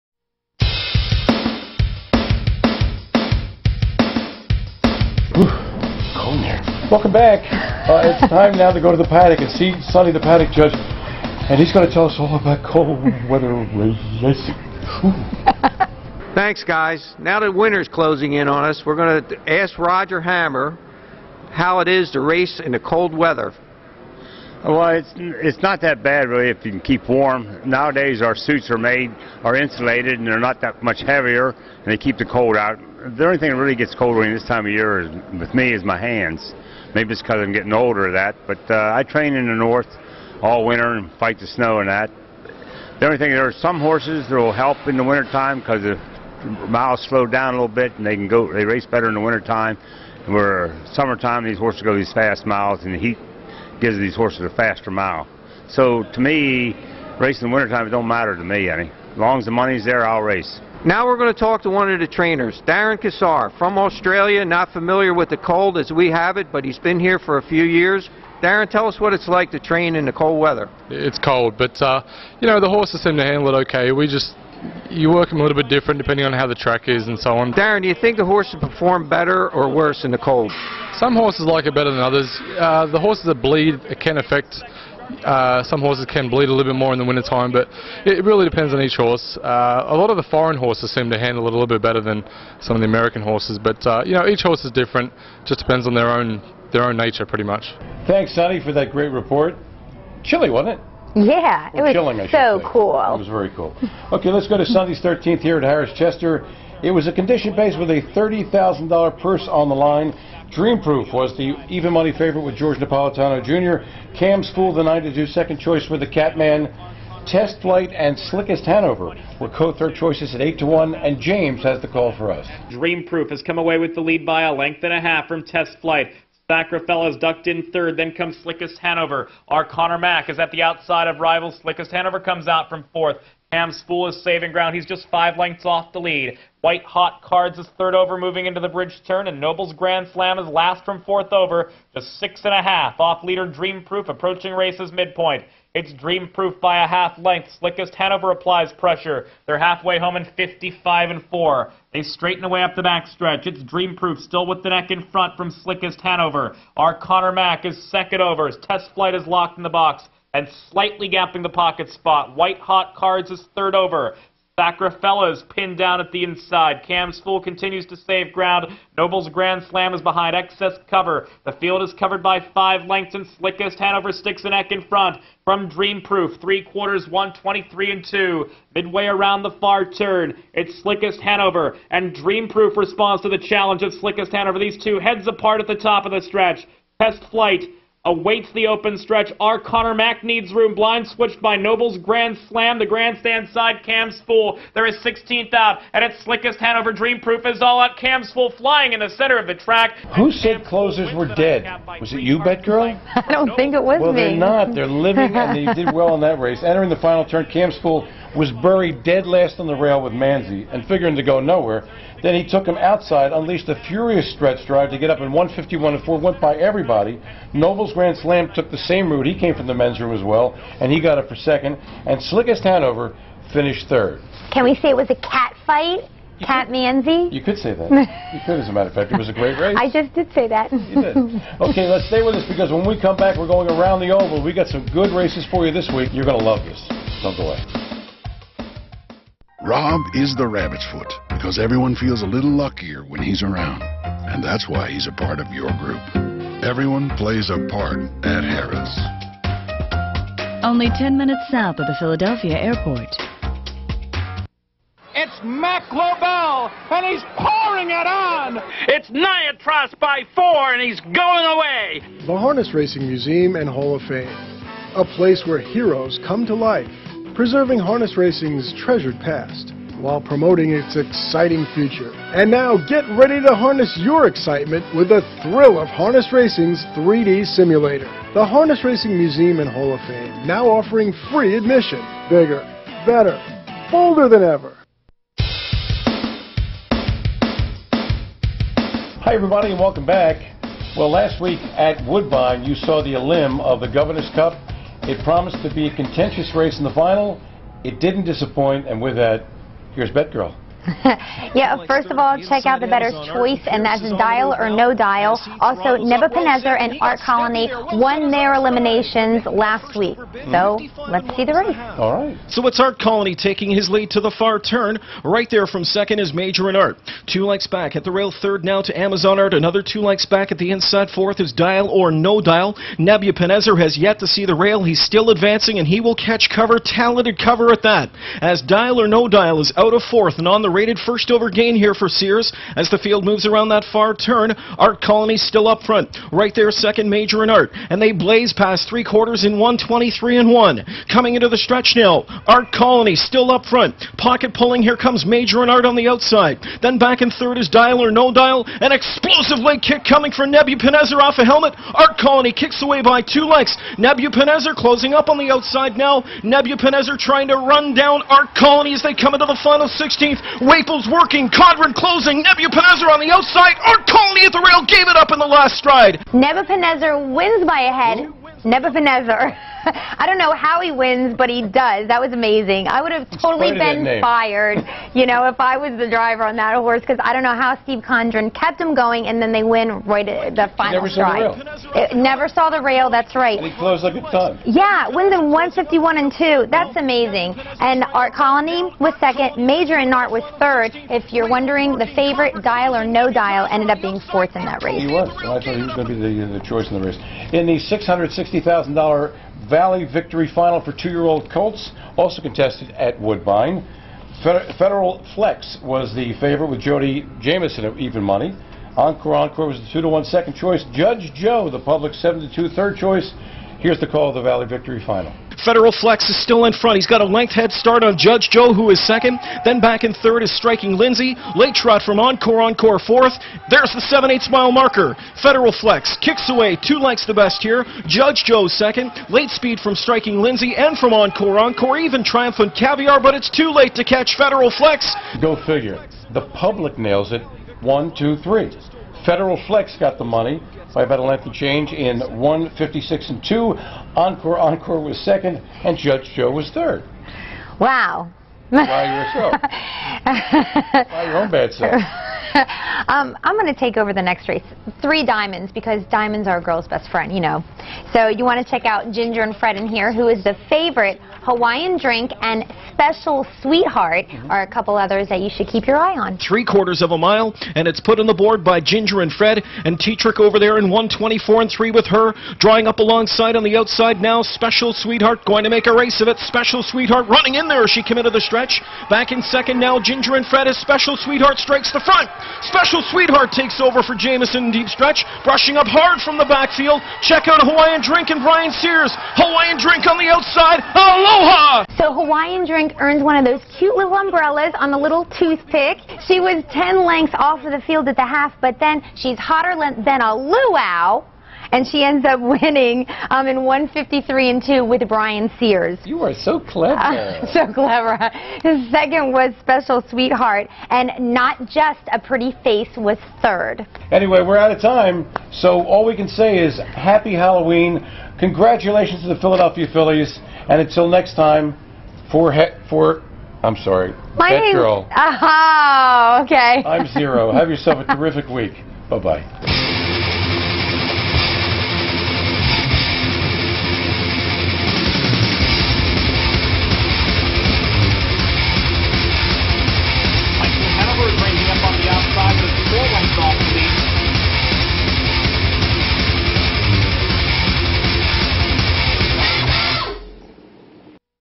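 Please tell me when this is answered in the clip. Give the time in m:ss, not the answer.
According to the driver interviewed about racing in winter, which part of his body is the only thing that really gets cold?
0:35.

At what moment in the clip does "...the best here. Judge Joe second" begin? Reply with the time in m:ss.
7:07.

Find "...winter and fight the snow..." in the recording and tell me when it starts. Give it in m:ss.
0:40.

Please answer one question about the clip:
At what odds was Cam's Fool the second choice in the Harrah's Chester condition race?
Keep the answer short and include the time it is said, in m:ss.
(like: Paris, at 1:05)
9-2, at 1:54.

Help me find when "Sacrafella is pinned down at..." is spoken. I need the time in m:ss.
2:44.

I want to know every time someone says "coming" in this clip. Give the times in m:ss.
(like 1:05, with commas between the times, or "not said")
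5:41, 5:50.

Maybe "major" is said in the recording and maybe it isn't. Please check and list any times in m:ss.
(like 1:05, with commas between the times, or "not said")
5:16, 5:37, 5:45, 6:29.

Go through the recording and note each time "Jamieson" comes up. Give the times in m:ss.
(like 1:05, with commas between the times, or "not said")
6:47, 8:04.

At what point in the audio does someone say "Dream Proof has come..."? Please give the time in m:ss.
2:02.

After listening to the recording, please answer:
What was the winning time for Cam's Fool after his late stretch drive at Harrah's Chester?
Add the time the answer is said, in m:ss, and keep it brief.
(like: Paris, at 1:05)
1:51.4, at 3:35.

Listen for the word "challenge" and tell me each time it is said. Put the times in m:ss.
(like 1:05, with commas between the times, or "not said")
3:03.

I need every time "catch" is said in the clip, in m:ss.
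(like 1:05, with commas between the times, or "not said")
5:26, 7:14.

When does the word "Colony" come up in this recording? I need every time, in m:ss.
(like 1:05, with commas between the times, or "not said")
5:07, 5:12, 5:35, 5:42, 5:52, 5:58, 6:04, 6:28.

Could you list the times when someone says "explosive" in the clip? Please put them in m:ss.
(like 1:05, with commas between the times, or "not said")
5:48.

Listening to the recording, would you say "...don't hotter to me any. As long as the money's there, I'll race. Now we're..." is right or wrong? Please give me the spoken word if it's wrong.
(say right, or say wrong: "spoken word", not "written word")
wrong: "matter", not "hotter".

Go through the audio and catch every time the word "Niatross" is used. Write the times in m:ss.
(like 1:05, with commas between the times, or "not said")
4:19.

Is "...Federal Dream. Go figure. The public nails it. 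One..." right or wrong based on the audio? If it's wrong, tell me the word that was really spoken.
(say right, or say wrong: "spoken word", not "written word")
wrong: "Flex", not "Dream".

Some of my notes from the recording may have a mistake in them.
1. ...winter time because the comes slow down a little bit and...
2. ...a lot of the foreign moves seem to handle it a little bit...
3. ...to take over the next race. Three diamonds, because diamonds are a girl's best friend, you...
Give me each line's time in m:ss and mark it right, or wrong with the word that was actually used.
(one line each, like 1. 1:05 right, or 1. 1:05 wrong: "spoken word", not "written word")
1. 0:45 wrong: "miles", not "comes"
2. 1:29 wrong: "horses", not "moves"
3. 7:33 right.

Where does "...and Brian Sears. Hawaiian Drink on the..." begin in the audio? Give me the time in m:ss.
8:08.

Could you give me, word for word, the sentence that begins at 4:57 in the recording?
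It didn't disappoint, and with that, here's Betgirl.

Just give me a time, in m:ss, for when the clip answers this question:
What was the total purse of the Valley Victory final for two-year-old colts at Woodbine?
6:37.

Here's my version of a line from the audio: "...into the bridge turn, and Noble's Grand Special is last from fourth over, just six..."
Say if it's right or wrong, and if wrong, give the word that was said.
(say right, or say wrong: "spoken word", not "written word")
wrong: "Slam", not "Special".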